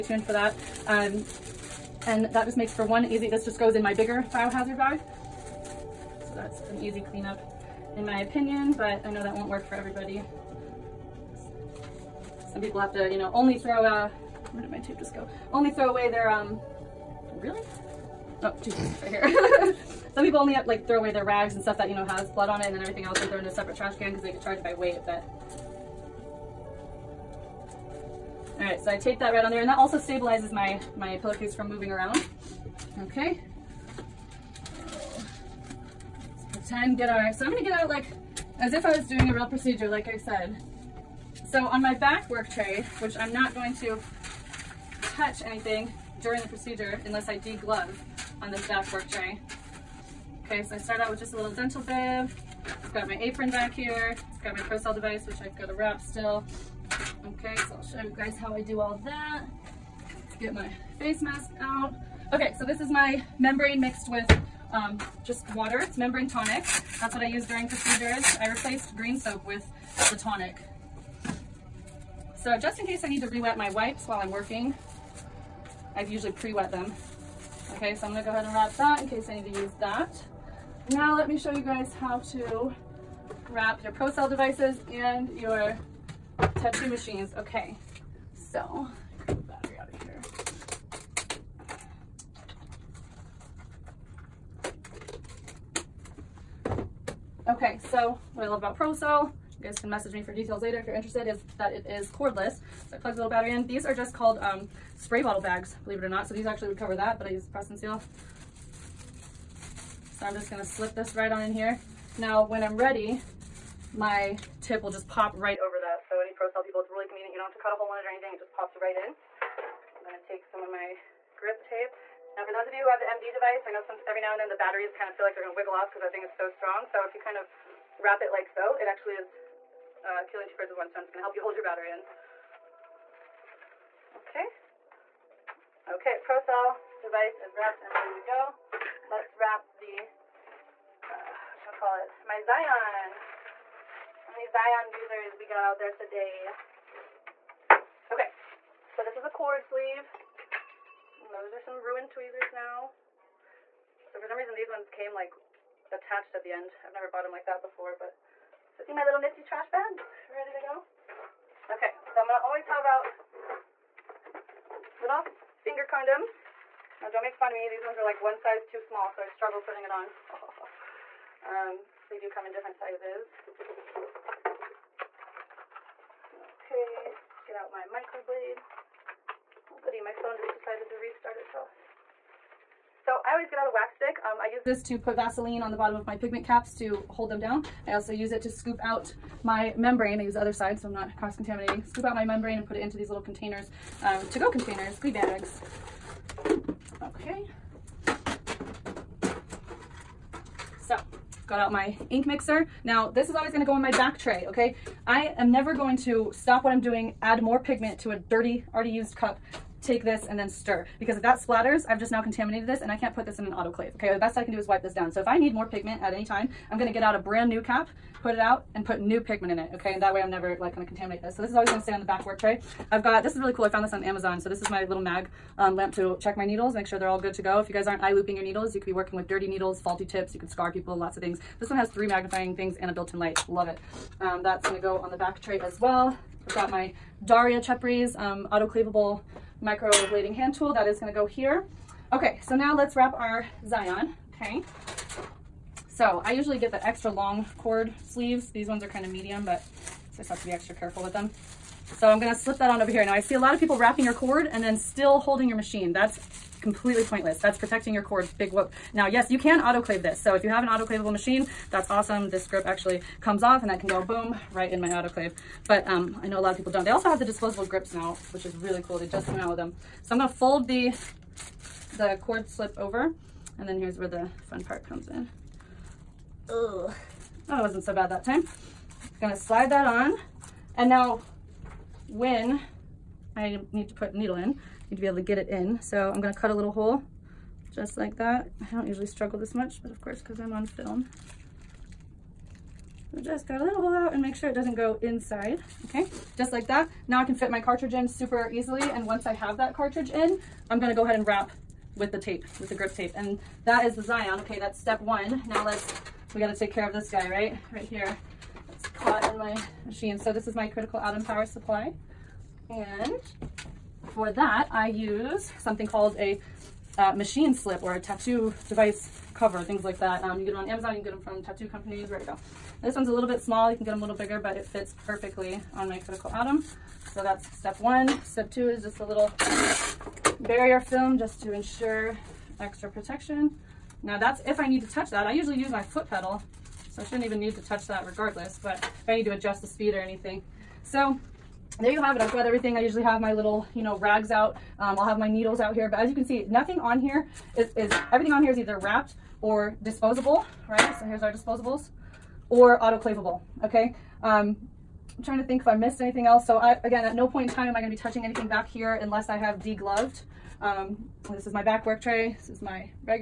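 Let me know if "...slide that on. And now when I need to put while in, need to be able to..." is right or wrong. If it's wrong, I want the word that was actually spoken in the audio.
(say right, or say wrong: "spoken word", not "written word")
wrong: "needle", not "while".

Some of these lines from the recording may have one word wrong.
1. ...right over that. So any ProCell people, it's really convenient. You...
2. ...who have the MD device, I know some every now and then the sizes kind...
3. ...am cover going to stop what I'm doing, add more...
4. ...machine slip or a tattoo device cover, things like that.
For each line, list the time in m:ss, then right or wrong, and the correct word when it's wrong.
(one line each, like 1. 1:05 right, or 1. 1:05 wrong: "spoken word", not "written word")
1. 1:55 right
2. 2:02 wrong: "batteries", not "sizes"
3. 3:25 wrong: "never", not "cover"
4. 5:17 right.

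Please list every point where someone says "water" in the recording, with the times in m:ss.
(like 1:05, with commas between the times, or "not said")
1:05.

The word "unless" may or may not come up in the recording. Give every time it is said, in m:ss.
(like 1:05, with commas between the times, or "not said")
0:47, 5:59.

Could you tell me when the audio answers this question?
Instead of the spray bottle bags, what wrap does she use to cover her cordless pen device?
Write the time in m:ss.
1:47.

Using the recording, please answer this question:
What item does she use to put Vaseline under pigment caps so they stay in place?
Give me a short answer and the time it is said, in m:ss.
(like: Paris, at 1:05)
wax stick, at 3:03.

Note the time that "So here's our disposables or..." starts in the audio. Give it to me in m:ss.
5:50.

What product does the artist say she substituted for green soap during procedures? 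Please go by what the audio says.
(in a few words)
membrane tonic.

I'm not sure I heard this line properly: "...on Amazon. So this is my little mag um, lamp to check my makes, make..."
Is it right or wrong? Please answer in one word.
wrong.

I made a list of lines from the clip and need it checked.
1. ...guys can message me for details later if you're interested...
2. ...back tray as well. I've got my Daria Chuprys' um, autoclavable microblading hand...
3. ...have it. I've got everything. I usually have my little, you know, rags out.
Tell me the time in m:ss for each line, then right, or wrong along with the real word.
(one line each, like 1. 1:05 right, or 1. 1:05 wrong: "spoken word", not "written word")
1. 1:39 right
2. 3:55 right
3. 5:42 right.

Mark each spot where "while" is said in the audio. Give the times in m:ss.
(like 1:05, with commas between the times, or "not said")
1:14.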